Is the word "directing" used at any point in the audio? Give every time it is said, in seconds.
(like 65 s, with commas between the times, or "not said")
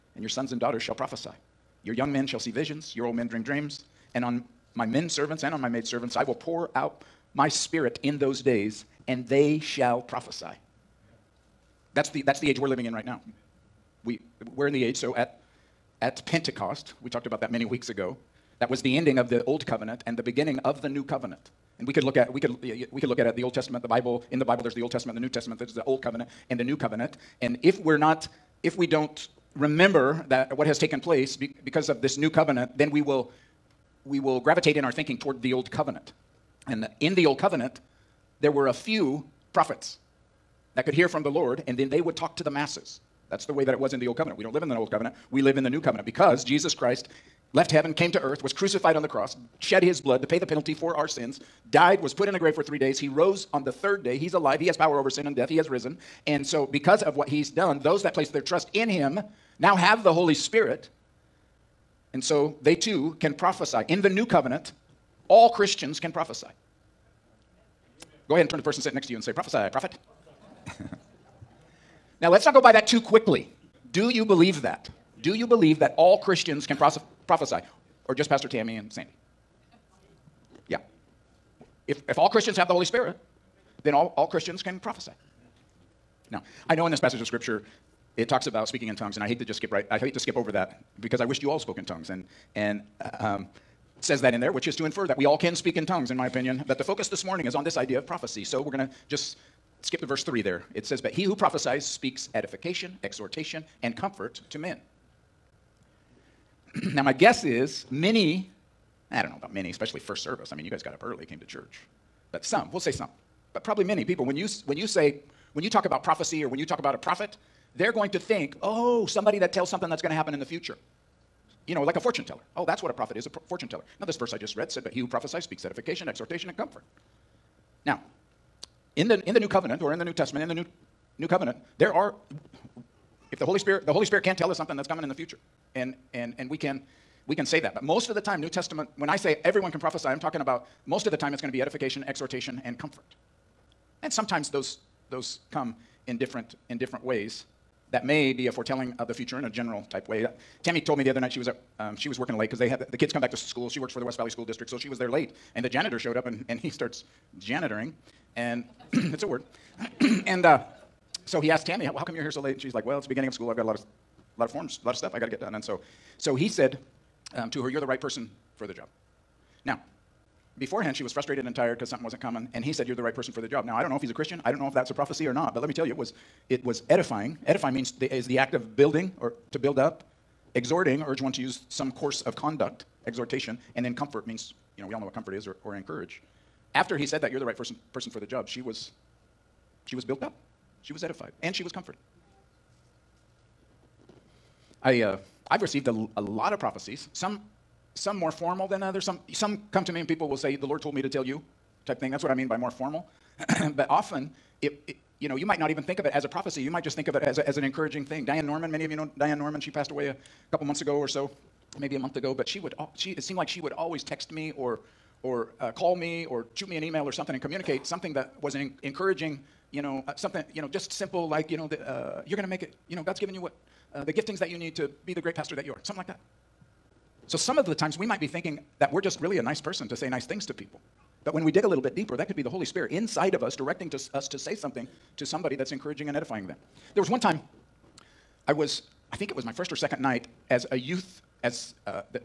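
233 s.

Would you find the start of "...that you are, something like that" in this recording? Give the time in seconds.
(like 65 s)
225 s.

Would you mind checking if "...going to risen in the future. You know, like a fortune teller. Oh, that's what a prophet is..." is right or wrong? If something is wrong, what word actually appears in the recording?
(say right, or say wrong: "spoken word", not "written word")
wrong: "happen", not "risen".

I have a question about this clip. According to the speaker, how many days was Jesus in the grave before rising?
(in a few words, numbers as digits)
3.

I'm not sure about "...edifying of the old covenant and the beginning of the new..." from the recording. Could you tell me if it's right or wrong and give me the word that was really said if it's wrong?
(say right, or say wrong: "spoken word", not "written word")
wrong: "ending", not "edifying".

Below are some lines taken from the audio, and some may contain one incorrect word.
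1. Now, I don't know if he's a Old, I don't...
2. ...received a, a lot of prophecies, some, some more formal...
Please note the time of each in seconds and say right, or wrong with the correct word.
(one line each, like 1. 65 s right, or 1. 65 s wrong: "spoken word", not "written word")
1. 173 s wrong: "Christian", not "Old"
2. 195 s right.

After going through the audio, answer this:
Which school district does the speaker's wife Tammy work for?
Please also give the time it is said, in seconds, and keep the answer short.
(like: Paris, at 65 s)
West Valley School District, at 154 s.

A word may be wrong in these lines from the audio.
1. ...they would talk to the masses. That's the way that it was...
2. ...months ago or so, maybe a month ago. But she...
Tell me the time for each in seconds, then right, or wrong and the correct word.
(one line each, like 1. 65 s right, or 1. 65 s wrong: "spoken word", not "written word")
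1. 41 s right
2. 210 s right.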